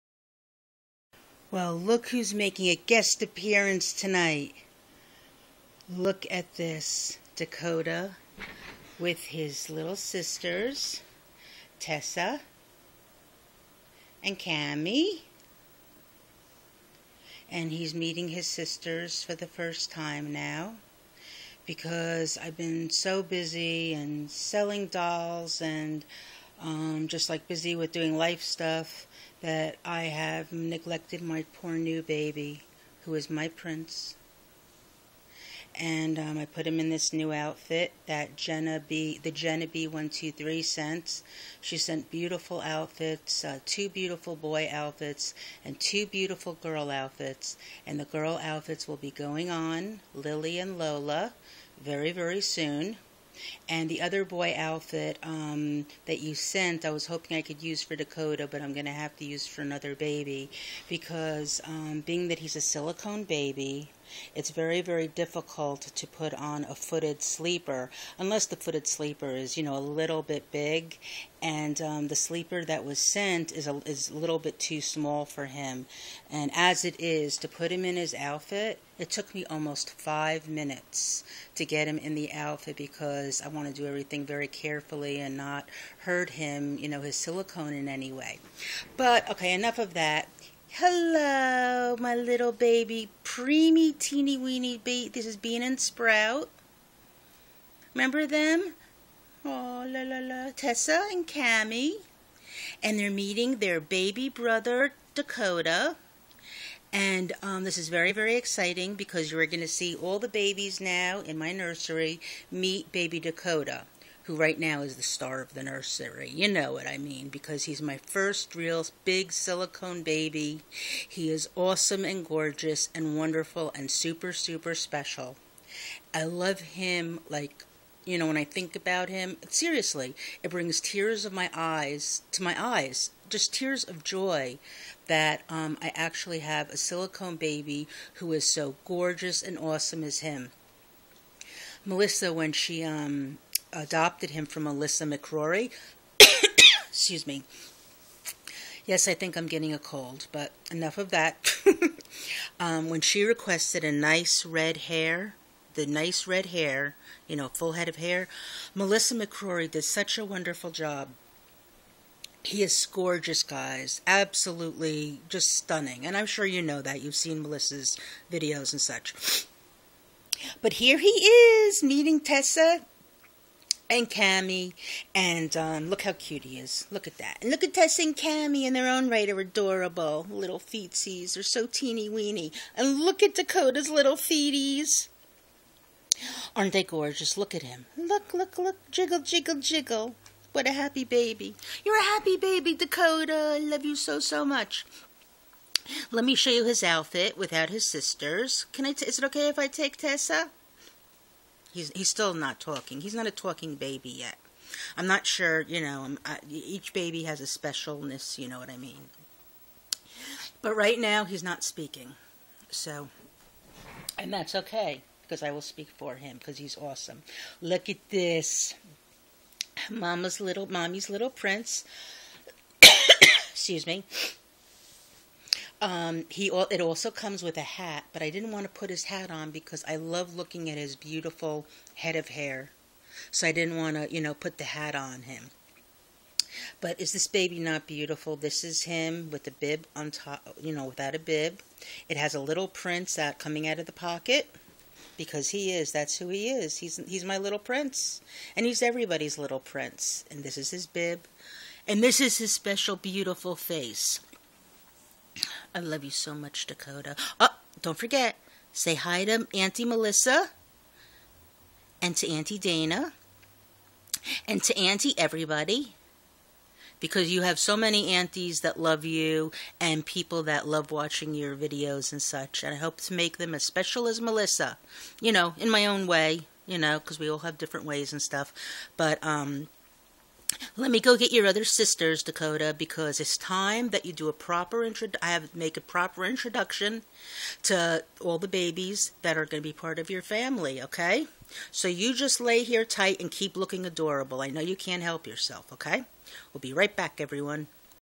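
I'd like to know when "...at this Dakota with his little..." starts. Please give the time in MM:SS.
00:06.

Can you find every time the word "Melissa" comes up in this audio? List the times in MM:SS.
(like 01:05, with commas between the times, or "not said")
02:21, 02:38, 02:47, 04:19, 04:34.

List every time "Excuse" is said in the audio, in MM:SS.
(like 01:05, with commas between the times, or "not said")
02:26, 03:42.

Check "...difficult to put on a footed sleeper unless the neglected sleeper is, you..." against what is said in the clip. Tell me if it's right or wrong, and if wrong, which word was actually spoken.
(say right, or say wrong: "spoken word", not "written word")
wrong: "footed", not "neglected".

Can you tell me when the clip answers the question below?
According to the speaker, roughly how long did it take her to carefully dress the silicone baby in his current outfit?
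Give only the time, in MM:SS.
01:19.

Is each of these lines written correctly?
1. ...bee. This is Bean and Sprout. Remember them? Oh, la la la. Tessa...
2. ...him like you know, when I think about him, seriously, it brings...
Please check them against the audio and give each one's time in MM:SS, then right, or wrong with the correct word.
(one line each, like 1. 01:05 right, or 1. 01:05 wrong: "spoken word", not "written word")
1. 01:34 right
2. 02:06 right.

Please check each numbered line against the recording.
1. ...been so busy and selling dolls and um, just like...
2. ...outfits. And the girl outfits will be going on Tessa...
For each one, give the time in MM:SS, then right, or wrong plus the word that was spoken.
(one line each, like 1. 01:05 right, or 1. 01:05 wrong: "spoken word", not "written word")
1. 00:22 right
2. 00:46 wrong: "Lily", not "Tessa".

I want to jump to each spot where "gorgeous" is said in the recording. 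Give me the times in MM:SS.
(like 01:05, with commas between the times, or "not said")
02:02, 02:18, 02:42, 03:06.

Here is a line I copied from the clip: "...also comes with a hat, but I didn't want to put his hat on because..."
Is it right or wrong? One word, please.
right.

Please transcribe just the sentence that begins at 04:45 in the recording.
I have make a proper introduction to all the babies that are going to be part of your family.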